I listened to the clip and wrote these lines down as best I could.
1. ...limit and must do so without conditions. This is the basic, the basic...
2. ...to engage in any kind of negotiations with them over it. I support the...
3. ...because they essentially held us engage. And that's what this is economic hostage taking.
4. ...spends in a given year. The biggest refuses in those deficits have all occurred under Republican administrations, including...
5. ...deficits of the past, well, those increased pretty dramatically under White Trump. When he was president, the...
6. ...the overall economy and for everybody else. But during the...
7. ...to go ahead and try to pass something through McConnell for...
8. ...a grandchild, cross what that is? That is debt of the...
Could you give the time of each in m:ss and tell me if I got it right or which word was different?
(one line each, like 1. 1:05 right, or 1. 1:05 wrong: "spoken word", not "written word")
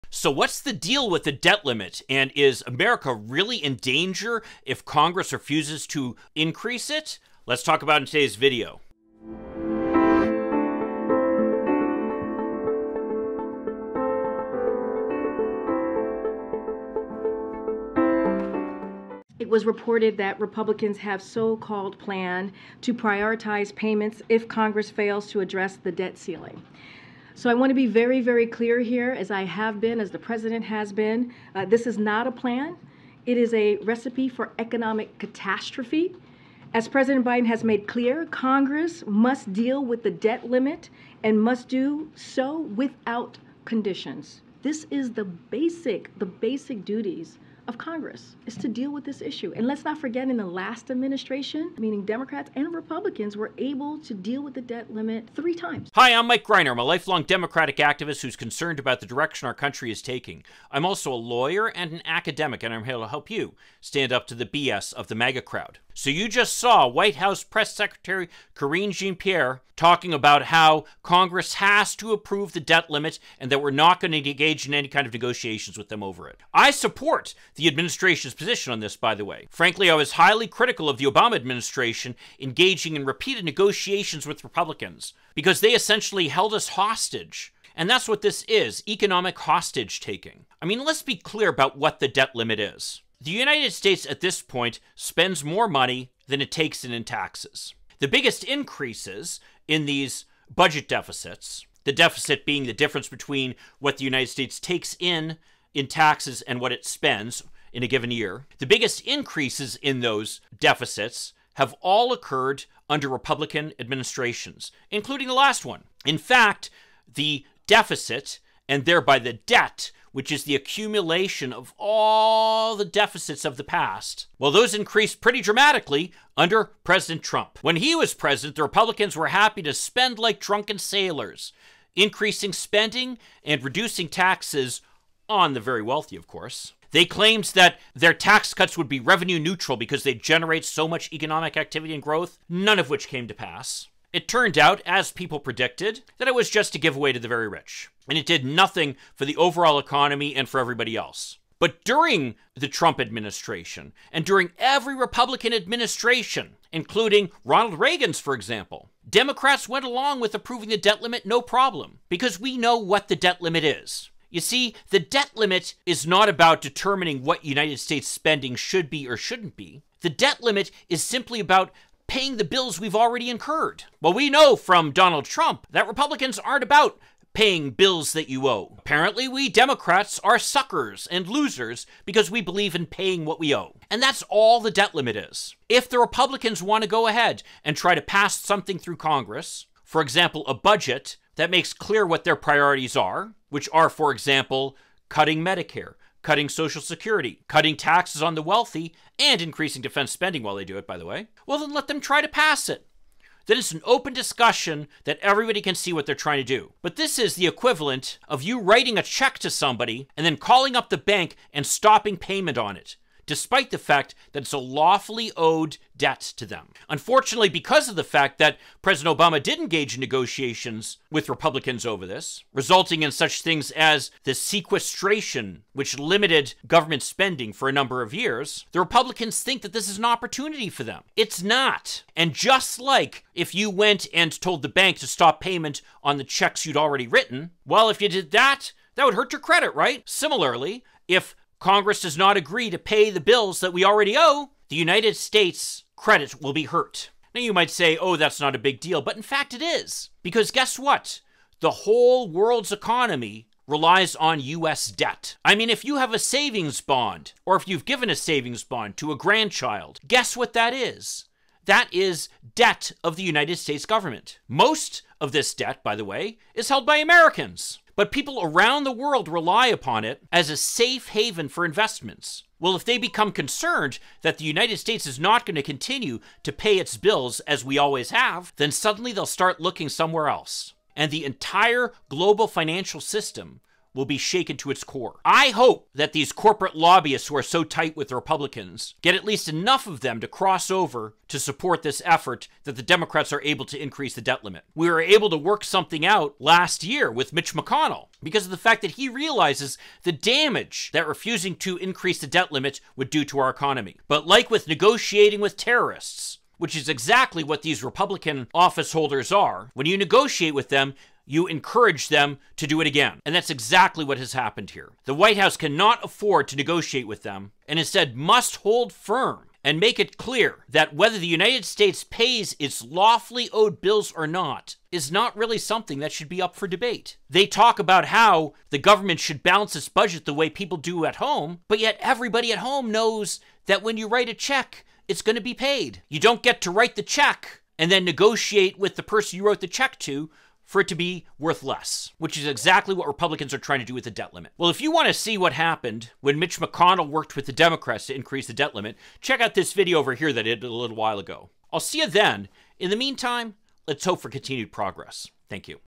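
1. 0:40 right
2. 1:14 right
3. 1:25 wrong: "hostage", not "engage"
4. 1:46 wrong: "increases", not "refuses"
5. 2:02 wrong: "President", not "White"
6. 2:29 right
7. 3:06 wrong: "Congress", not "McConnell"
8. 4:19 wrong: "guess", not "cross".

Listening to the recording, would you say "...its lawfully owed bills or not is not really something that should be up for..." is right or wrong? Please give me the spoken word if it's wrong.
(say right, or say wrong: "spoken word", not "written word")
right.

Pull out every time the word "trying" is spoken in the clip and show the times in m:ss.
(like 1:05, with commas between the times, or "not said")
3:26, 5:43.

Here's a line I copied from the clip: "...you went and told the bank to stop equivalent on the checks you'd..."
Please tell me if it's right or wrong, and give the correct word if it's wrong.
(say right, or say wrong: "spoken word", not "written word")
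wrong: "payment", not "equivalent".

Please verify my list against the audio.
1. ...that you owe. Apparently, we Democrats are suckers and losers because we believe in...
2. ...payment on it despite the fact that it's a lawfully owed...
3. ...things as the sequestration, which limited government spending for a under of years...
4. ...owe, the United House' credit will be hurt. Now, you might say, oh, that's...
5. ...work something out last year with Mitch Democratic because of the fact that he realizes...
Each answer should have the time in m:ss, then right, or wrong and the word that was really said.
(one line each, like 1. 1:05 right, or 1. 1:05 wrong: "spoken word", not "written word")
1. 2:58 right
2. 3:32 right
3. 3:43 wrong: "number", not "under"
4. 4:04 wrong: "States", not "House"
5. 4:55 wrong: "McConnell", not "Democratic".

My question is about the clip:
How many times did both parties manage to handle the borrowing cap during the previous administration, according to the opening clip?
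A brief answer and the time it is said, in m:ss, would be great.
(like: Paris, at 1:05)
3, at 0:55.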